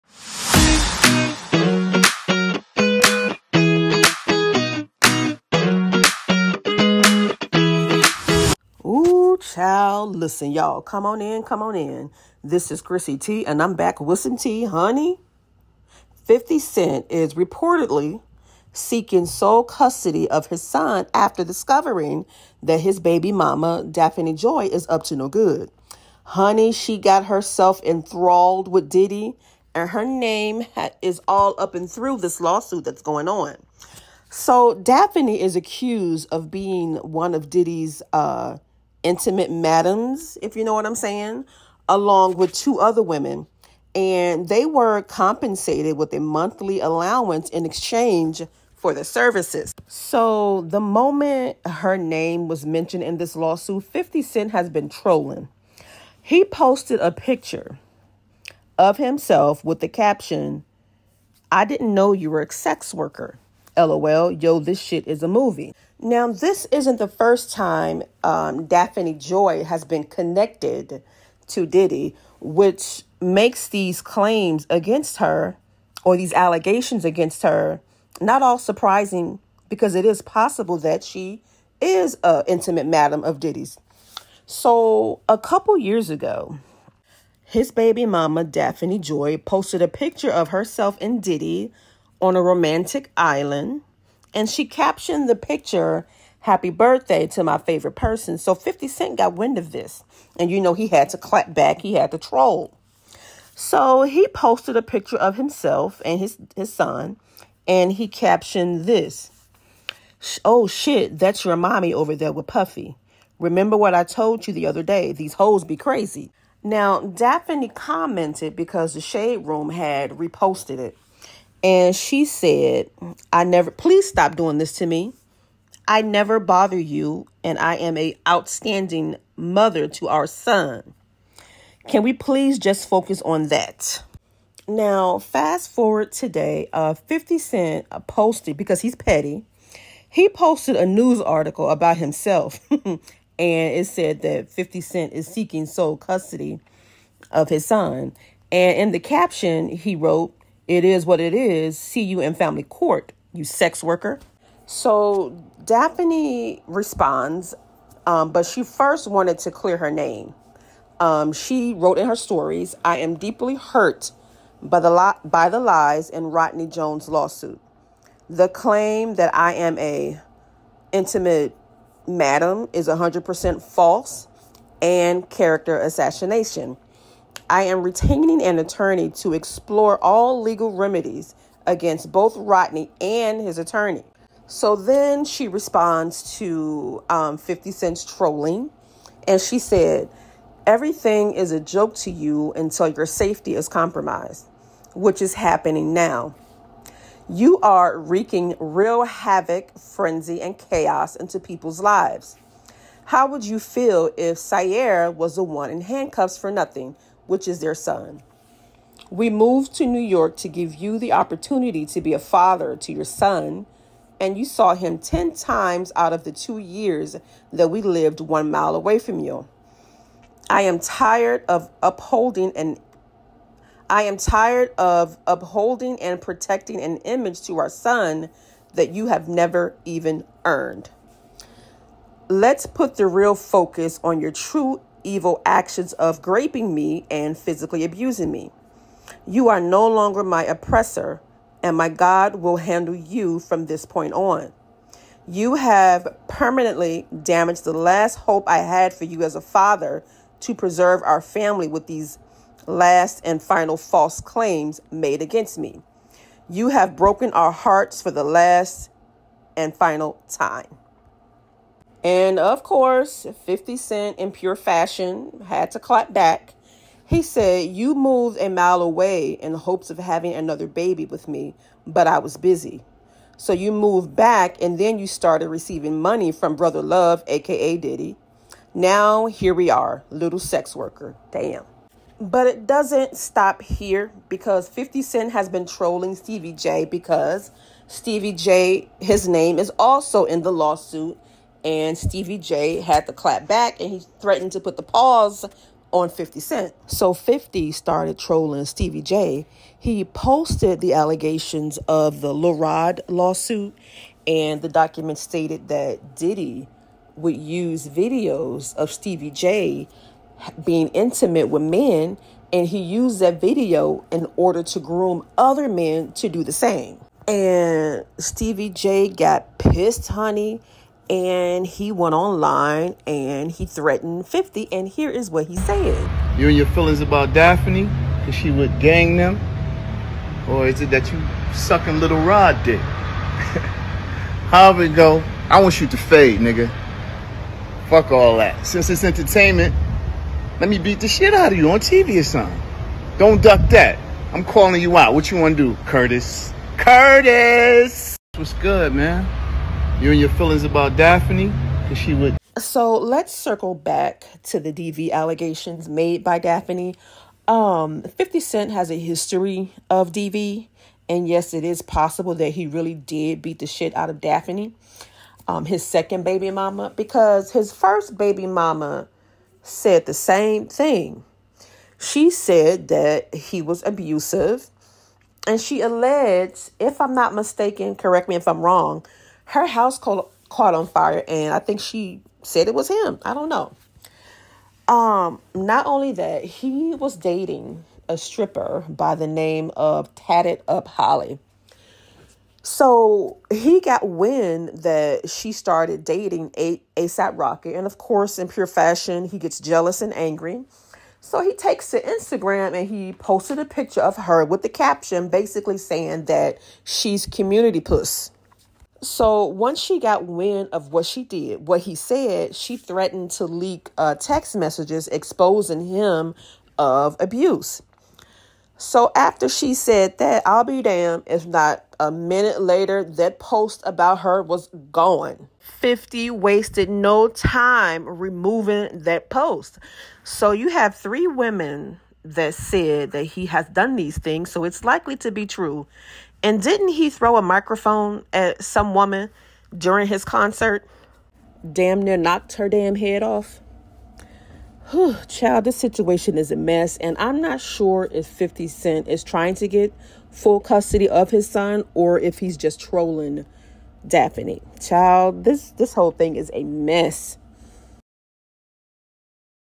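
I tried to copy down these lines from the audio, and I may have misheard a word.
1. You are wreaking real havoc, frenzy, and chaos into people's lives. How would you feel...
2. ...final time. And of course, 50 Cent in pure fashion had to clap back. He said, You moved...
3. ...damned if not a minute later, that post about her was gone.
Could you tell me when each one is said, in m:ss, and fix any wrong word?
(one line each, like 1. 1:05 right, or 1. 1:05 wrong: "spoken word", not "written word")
1. 3:17 right
2. 4:19 right
3. 7:00 right.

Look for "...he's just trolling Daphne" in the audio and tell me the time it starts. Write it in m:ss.
7:32.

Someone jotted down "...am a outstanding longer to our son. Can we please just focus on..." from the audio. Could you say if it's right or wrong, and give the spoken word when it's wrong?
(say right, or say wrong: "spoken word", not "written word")
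wrong: "mother", not "longer".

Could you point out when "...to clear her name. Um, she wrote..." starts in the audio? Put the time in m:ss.
2:39.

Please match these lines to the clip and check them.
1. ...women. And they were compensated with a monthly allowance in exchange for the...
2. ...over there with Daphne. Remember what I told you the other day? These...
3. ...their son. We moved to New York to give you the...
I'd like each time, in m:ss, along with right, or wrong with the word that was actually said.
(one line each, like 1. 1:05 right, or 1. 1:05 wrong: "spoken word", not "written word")
1. 0:43 right
2. 1:51 wrong: "Puffy", not "Daphne"
3. 3:27 right.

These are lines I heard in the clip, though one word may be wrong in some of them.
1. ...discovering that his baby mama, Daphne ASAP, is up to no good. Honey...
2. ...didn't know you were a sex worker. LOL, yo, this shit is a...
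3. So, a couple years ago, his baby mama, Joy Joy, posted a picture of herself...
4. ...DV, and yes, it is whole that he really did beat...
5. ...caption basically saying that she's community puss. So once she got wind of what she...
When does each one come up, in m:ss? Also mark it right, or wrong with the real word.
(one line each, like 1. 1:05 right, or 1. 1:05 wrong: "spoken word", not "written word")
1. 0:21 wrong: "Joy", not "ASAP"
2. 1:01 right
3. 1:24 wrong: "Daphne", not "Joy"
4. 6:00 wrong: "possible", not "whole"
5. 6:44 right.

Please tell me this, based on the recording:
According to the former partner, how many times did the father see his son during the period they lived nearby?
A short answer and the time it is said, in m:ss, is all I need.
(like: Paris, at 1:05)
10, at 3:34.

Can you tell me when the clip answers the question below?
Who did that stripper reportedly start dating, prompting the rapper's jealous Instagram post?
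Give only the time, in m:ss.
6:36.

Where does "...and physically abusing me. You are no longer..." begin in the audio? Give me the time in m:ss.
3:57.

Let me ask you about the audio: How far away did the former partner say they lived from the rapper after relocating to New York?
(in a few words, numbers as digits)
one mile.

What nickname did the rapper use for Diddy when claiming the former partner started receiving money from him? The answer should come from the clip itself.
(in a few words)
Brother Love.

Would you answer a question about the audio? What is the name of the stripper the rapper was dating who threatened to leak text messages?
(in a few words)
Tatted Up Holly.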